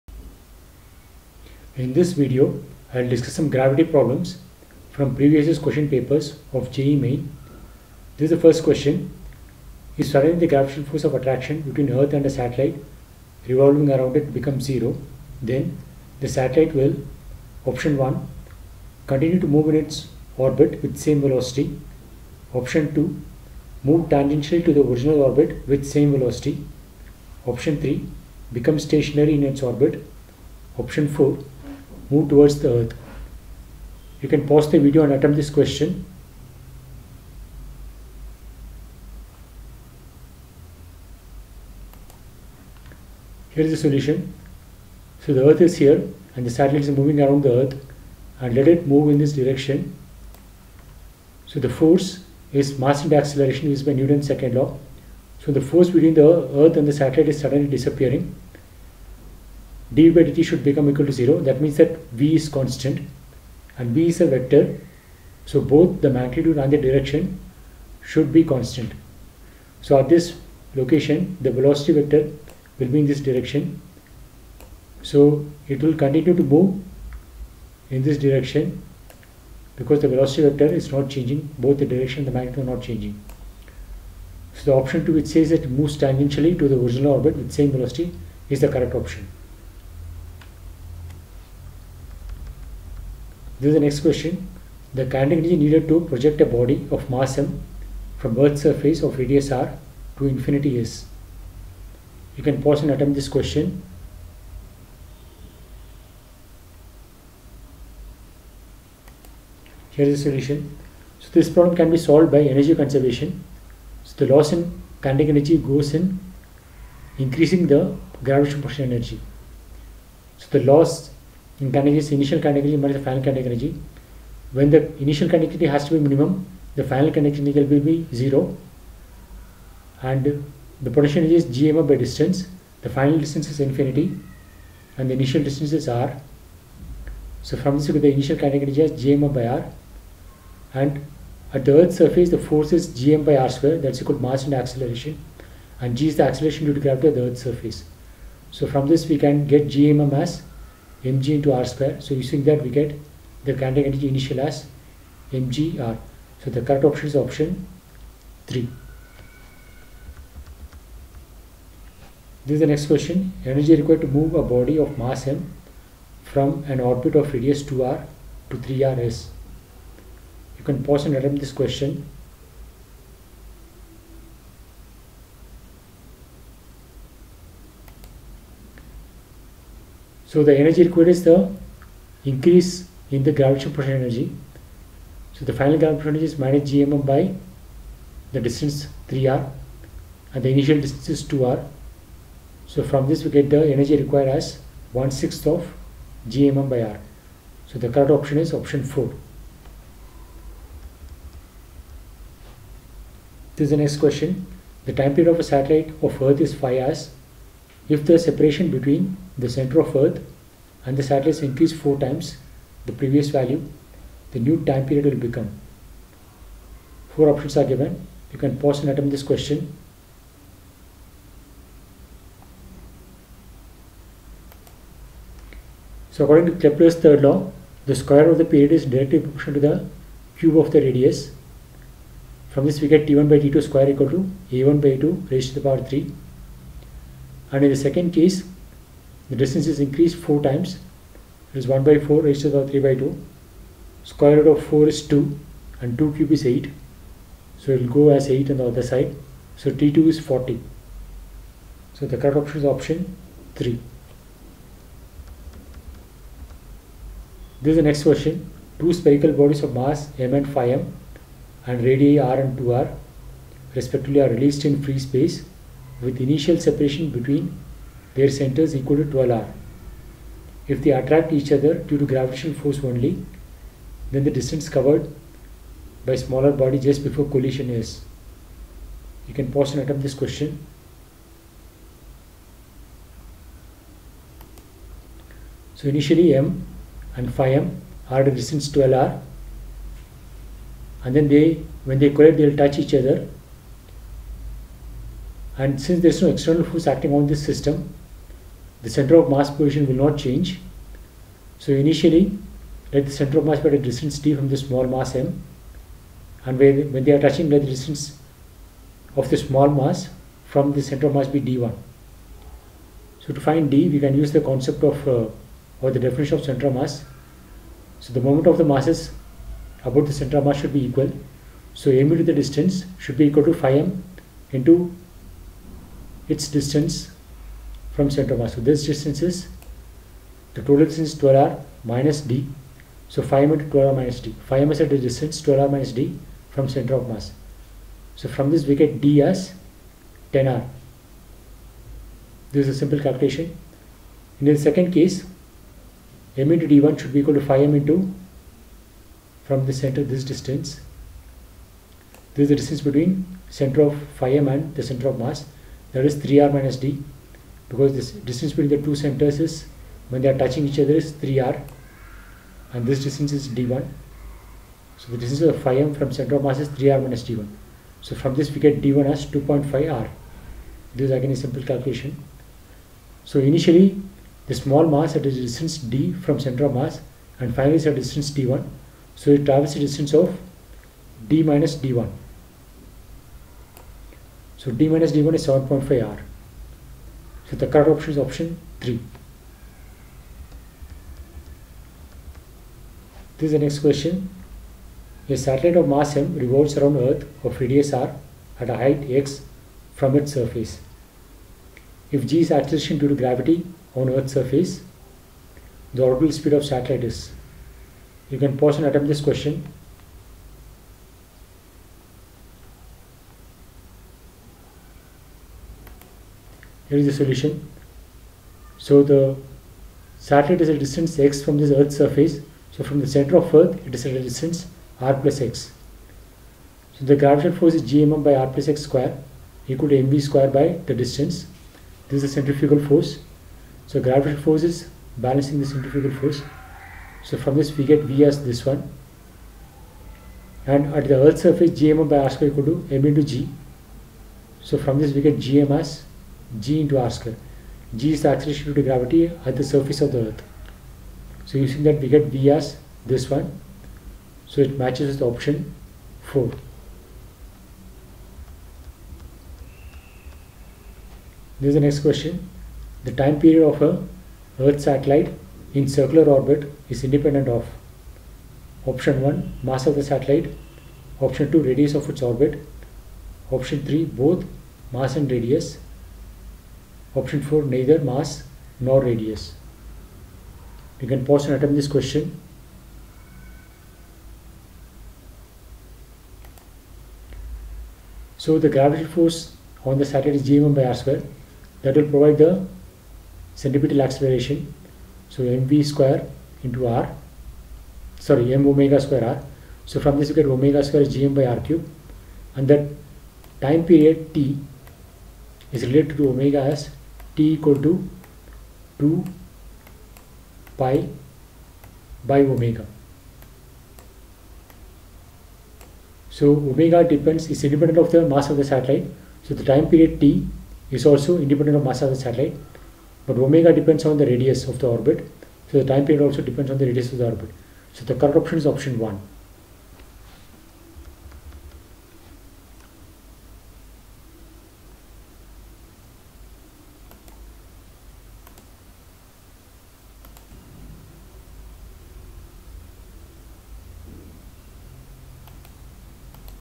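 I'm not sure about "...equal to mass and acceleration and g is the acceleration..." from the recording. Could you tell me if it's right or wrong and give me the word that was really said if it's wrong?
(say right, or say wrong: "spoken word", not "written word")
right.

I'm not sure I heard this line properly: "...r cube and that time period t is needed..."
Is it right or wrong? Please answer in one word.
wrong.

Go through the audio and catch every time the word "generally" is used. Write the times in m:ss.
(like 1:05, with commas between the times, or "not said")
not said.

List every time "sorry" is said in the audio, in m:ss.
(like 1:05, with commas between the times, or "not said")
8:18.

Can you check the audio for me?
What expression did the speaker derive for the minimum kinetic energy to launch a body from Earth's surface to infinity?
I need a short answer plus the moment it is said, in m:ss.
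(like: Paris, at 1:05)
mgr, at 2:35.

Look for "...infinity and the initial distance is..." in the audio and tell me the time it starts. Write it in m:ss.
2:13.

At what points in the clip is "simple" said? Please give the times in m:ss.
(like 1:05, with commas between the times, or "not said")
5:42, 6:11.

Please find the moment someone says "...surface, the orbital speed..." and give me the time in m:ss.
6:44.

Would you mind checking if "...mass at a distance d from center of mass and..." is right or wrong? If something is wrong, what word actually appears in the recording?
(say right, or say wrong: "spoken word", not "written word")
right.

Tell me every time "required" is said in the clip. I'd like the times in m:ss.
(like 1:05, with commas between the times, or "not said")
2:43, 3:00, 3:13.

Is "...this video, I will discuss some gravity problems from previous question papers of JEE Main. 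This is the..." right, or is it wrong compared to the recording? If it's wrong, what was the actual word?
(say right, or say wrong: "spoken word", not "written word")
right.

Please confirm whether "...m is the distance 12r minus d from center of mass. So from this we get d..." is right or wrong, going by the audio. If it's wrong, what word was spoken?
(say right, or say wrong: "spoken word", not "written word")
right.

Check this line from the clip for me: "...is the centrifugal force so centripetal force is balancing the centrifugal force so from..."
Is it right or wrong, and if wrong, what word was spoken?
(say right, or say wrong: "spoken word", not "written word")
wrong: "gravitational", not "centripetal".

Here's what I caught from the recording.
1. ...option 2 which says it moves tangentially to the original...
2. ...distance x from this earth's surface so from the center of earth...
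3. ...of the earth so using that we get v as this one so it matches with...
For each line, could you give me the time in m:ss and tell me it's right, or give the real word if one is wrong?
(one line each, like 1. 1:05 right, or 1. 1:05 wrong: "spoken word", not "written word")
1. 1:24 right
2. 7:00 right
3. 7:30 right.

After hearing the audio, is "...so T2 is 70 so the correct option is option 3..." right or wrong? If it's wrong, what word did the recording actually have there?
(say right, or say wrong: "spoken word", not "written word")
wrong: "40", not "70".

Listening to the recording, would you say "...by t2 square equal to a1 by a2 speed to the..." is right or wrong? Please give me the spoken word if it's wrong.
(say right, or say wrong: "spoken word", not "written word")
wrong: "raised", not "speed".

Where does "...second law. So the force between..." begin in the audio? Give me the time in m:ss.
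0:54.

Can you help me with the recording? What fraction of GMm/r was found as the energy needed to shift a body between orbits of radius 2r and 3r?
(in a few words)
1/6.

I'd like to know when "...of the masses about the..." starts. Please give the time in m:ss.
5:18.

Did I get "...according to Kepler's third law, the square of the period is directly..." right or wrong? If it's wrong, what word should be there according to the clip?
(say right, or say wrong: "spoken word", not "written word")
right.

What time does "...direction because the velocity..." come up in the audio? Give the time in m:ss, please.
1:18.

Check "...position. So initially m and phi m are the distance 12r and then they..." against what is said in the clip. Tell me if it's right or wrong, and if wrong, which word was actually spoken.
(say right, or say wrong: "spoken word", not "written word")
wrong: "question", not "position".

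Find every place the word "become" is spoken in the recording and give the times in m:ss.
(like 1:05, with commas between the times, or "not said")
0:14, 0:28, 1:00, 3:35.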